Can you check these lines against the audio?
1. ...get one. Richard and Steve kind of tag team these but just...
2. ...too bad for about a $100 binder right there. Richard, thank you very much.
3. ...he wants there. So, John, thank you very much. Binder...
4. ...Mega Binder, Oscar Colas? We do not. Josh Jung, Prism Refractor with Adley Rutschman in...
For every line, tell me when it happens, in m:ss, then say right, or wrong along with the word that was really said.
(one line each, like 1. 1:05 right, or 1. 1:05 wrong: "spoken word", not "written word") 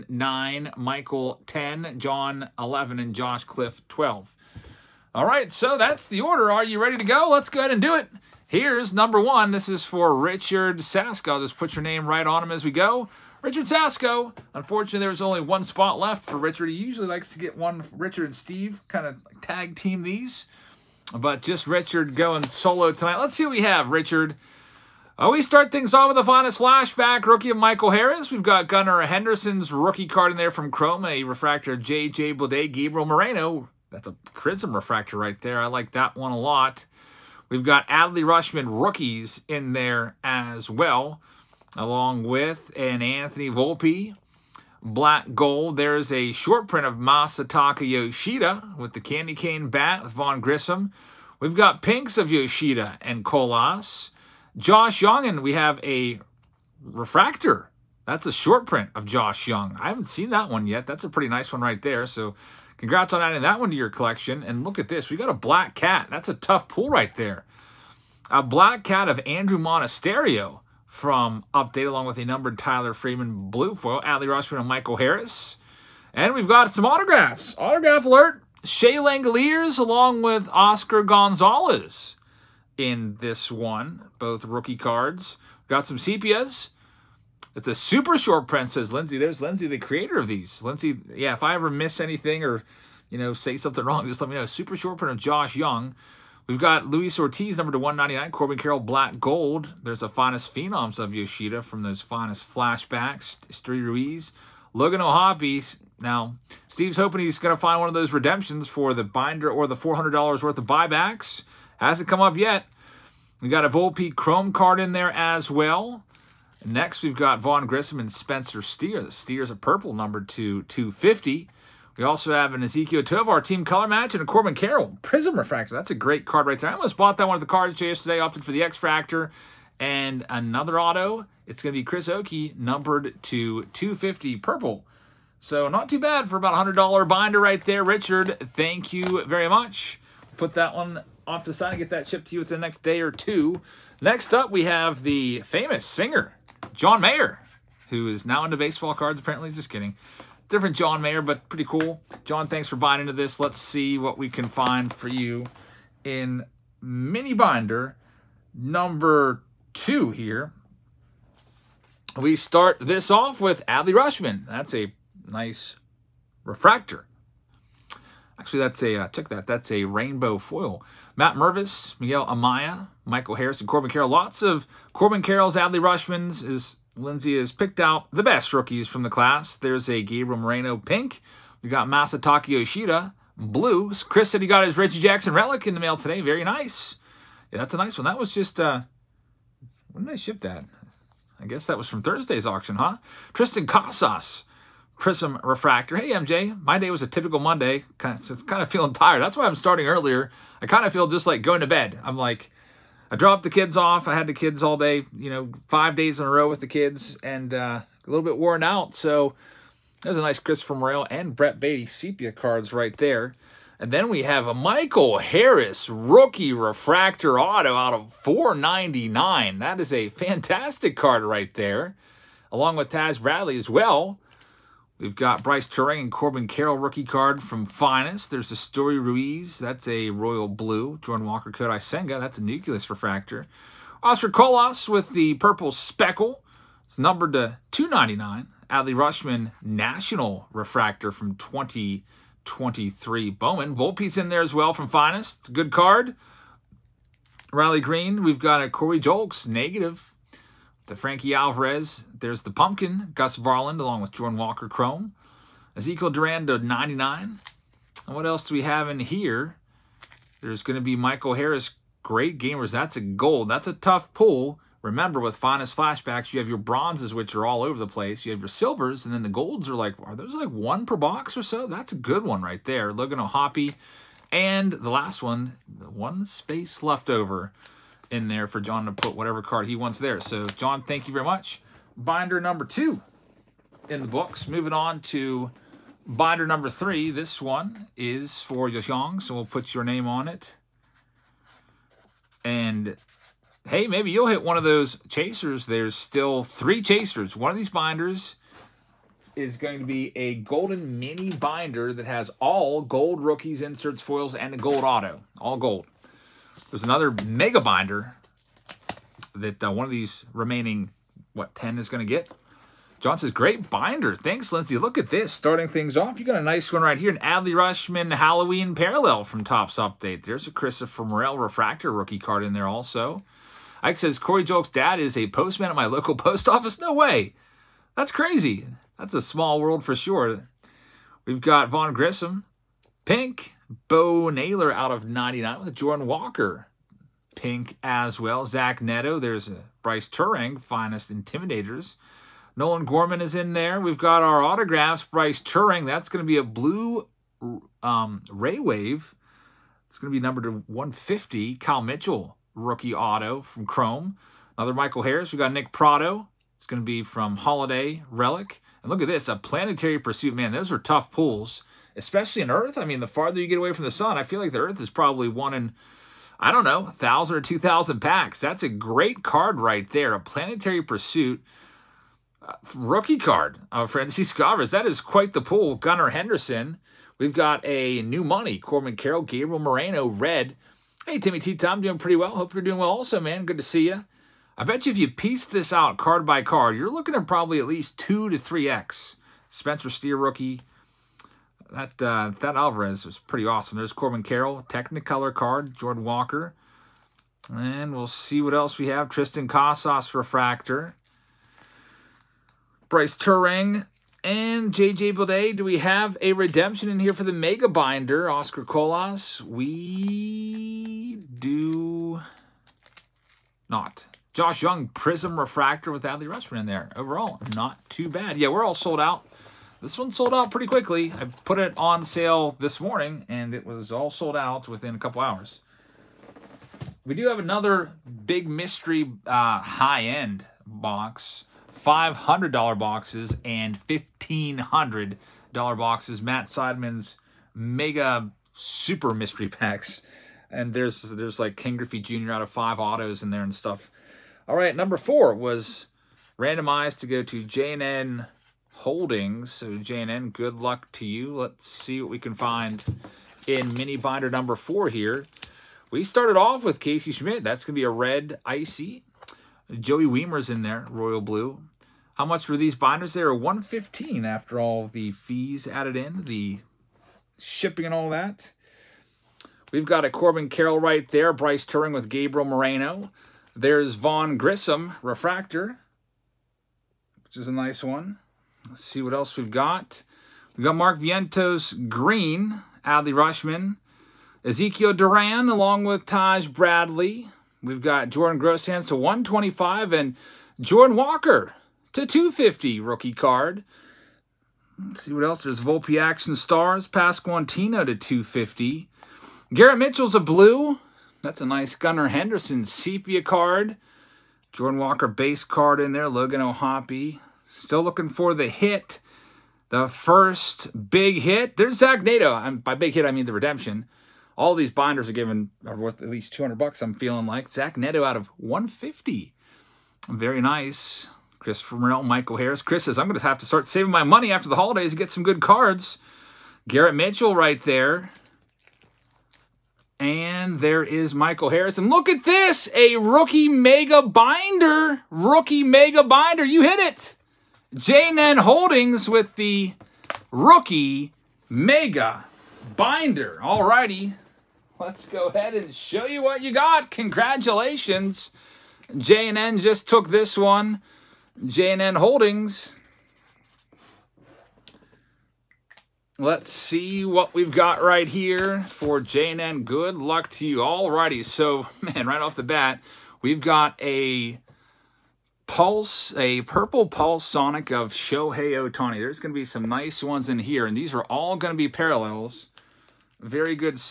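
1. 0:17 right
2. 2:15 right
3. 4:39 right
4. 6:47 right.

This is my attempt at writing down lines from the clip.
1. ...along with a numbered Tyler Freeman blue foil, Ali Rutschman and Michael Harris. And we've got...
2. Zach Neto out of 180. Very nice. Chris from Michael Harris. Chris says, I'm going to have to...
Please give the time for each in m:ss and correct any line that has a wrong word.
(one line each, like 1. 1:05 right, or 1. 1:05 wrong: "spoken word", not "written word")
1. 1:11 right
2. 8:37 wrong: "150", not "180".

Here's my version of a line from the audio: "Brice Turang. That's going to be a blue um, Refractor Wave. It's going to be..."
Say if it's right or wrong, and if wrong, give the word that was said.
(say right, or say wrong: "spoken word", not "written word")
wrong: "Ray", not "Refractor".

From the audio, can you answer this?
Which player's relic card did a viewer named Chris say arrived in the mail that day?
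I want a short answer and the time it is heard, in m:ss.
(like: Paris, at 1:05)
Reggie Jackson, at 3:04.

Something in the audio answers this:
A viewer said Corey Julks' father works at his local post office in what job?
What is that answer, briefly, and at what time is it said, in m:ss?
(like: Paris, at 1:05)
postman, at 5:25.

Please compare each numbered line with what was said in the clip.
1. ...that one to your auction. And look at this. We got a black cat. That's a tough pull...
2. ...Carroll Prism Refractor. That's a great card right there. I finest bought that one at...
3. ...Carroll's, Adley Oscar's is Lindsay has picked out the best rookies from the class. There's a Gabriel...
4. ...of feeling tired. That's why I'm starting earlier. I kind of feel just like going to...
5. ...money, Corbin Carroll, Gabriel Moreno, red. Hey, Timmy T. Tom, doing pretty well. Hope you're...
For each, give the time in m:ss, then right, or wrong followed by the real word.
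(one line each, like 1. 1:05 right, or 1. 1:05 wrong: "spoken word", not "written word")
1. 1:03 wrong: "collection", not "auction"
2. 2:04 wrong: "almost", not "finest"
3. 2:55 wrong: "Rutschman", not "Oscar"
4. 3:18 right
5. 6:18 right.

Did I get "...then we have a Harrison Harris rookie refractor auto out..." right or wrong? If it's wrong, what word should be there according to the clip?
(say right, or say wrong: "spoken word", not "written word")
wrong: "Michael", not "Harrison".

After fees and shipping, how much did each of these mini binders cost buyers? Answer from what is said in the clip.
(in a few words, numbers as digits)
115.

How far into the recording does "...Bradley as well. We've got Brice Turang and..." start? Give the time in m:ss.
3:43.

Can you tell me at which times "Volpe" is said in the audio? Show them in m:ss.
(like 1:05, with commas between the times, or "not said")
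0:43, 1:53, 4:03, 8:15.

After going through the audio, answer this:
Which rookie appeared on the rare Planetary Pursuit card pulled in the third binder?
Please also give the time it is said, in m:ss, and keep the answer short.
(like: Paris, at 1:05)
Francisco Alvarez, at 6:13.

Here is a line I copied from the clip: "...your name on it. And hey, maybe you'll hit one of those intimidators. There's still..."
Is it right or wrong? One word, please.
wrong.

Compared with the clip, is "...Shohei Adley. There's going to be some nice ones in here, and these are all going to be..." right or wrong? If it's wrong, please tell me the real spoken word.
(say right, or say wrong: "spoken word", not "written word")
wrong: "Ohtani", not "Adley".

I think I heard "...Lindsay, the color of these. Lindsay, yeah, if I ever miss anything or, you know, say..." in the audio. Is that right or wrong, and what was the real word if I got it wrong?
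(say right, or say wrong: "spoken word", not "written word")
wrong: "creator", not "color".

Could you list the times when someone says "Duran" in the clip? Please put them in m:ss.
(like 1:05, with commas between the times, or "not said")
4:16, 8:04.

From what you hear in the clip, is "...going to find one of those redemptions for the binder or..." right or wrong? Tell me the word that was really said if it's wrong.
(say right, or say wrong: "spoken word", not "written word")
right.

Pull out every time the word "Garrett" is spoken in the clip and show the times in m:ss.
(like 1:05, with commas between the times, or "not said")
8:19, 8:46.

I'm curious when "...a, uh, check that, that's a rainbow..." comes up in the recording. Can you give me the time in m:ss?
2:48.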